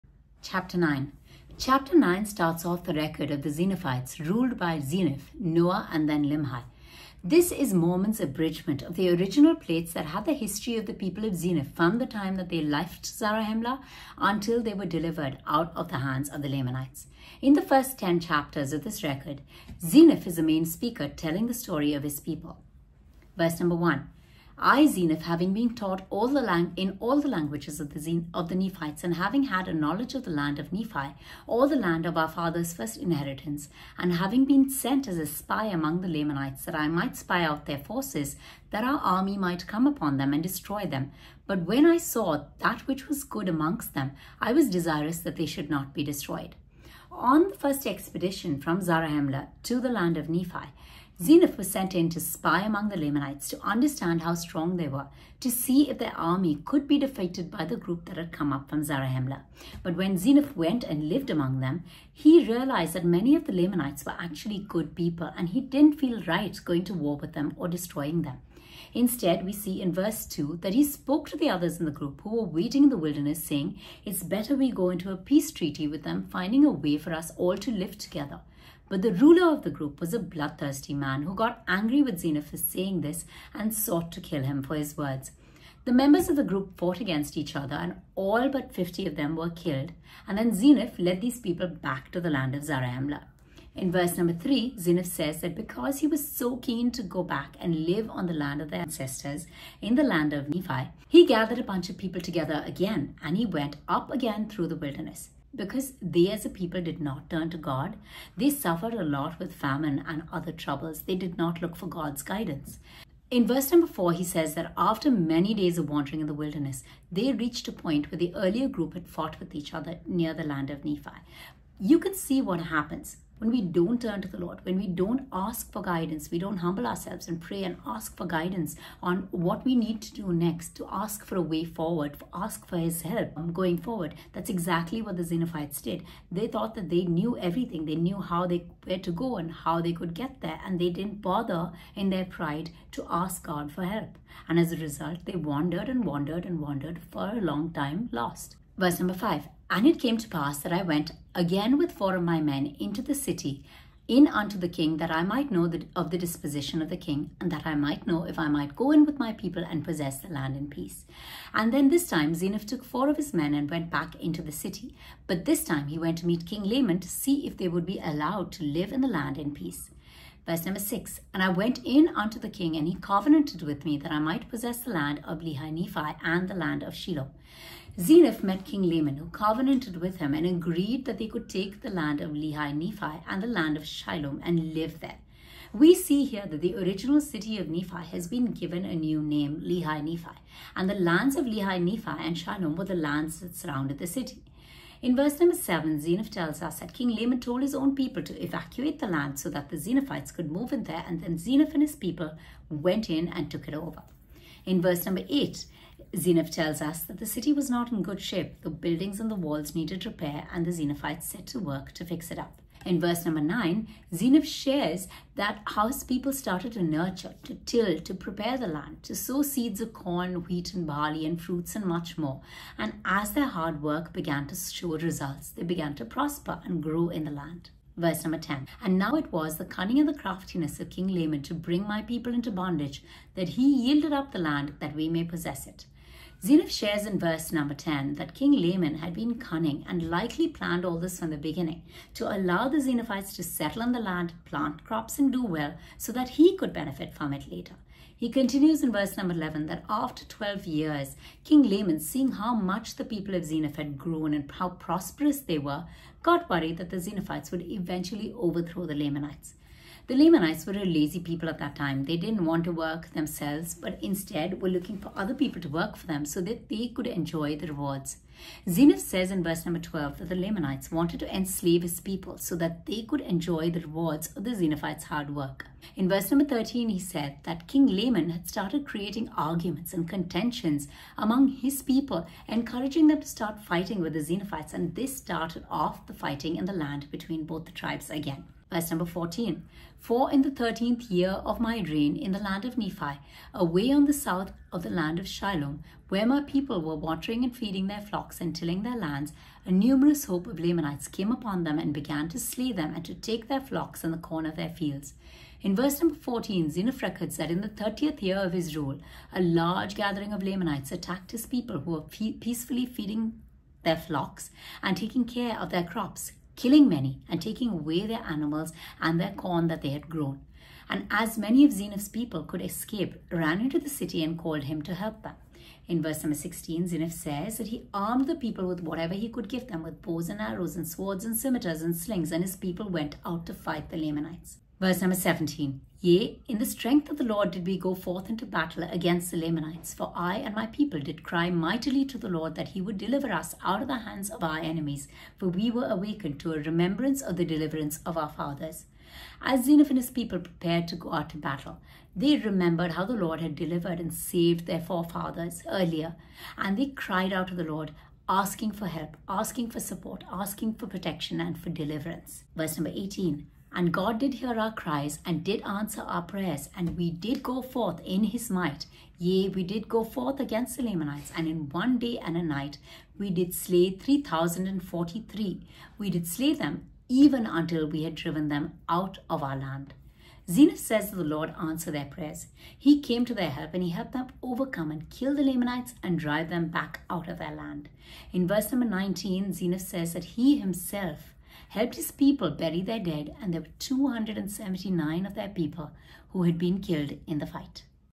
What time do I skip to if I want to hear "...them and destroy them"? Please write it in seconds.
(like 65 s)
40 s.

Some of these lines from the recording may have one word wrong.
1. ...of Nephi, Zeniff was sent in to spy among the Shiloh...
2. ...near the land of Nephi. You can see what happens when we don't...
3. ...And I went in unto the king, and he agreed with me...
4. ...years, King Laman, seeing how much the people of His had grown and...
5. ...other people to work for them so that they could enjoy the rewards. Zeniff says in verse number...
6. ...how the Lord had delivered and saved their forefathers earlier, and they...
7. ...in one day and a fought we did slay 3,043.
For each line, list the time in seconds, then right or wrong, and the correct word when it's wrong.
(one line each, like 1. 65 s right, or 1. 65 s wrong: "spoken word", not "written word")
1. 50 s wrong: "Lamanites", not "Shiloh"
2. 120 s right
3. 171 s wrong: "covenanted", not "agreed"
4. 250 s wrong: "Zeniff", not "His"
5. 265 s right
6. 352 s right
7. 371 s wrong: "night", not "fought".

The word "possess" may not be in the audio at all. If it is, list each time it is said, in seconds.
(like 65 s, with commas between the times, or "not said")
159 s, 174 s, 235 s.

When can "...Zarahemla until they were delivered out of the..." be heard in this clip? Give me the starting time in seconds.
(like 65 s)
13 s.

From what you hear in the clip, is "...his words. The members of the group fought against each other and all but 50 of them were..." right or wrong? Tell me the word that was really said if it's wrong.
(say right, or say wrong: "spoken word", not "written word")
right.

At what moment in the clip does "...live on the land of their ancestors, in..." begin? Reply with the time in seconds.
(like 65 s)
97 s.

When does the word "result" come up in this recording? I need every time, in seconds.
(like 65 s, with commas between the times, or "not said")
144 s, 224 s.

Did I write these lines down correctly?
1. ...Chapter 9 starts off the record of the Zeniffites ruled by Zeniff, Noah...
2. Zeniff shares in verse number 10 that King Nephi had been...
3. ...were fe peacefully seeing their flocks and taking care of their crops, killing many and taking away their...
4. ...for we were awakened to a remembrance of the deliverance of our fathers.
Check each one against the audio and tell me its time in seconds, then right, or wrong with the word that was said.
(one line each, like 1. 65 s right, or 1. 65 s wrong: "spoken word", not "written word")
1. 1 s right
2. 236 s wrong: "Laman", not "Nephi"
3. 311 s wrong: "feeding", not "seeing"
4. 345 s right.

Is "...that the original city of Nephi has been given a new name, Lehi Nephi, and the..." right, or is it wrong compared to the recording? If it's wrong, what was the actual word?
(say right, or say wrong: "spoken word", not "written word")
right.